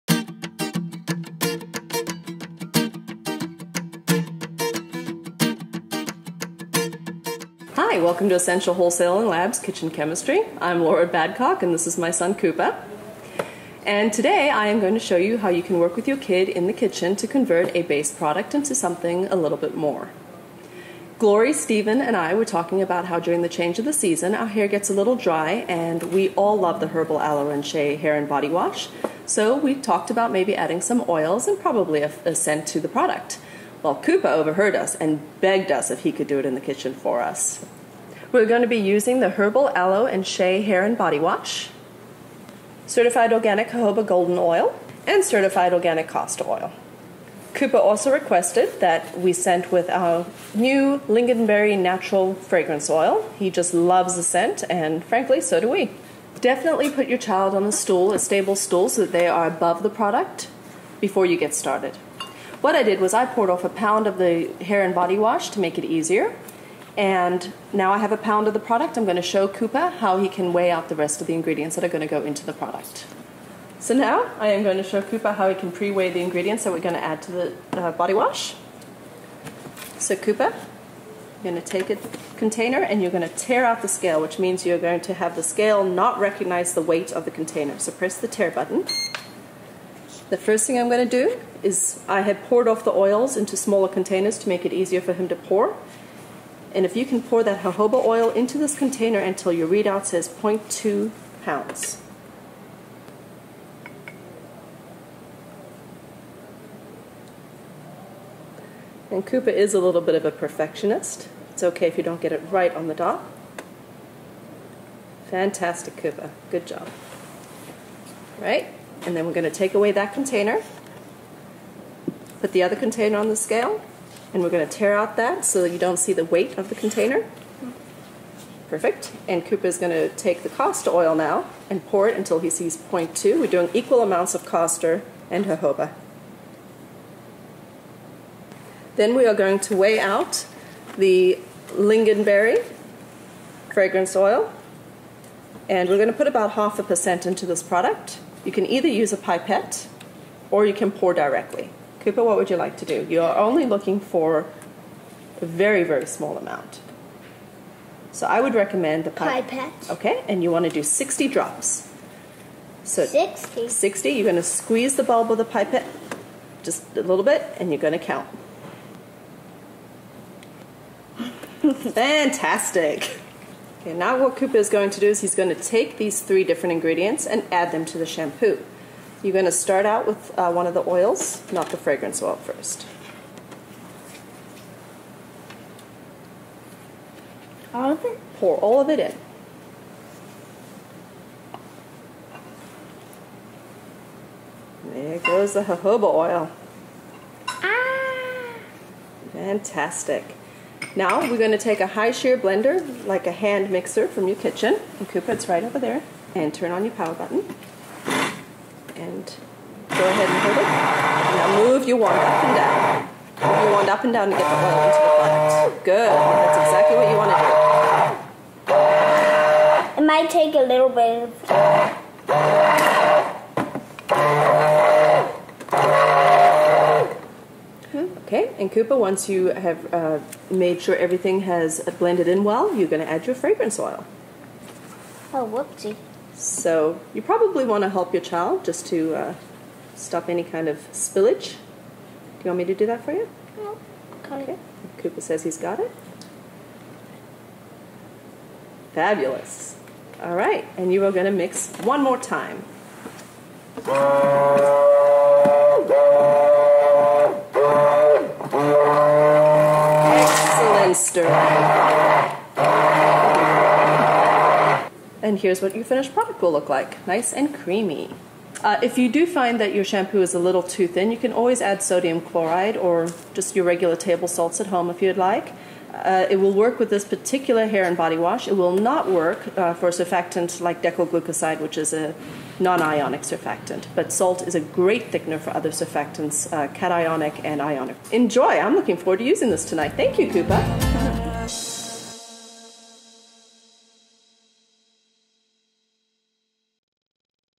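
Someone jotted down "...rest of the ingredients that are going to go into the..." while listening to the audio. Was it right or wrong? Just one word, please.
right.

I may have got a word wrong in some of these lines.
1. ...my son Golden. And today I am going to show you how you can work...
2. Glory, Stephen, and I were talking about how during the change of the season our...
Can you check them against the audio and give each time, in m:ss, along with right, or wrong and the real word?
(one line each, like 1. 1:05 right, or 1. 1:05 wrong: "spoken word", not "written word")
1. 0:11 wrong: "Cooper", not "Golden"
2. 0:21 right.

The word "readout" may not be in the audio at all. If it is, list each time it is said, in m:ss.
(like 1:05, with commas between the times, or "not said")
1:39.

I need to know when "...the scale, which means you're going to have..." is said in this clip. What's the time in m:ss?
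1:23.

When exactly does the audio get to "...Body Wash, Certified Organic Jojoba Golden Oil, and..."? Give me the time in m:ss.
0:40.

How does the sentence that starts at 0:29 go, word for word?
So we talked about maybe adding some oils and probably a, a scent to the product.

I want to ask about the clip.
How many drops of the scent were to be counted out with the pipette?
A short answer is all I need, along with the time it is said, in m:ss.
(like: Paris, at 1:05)
60, at 2:40.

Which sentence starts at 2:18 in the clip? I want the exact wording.
Then we are going to weigh out the lingonberry fragrance oil.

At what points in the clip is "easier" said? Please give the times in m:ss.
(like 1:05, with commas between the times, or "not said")
1:05, 1:34.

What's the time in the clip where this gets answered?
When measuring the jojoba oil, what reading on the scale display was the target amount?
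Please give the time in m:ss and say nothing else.
1:40.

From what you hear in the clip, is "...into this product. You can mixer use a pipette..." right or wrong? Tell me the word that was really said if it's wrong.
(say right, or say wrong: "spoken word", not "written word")
wrong: "either", not "mixer".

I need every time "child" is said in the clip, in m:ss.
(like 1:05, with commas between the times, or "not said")
0:57, 3:58.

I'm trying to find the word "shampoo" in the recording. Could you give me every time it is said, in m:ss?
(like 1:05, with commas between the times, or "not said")
2:58, 4:29.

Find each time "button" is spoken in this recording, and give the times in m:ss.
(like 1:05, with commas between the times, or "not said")
1:28, 3:27.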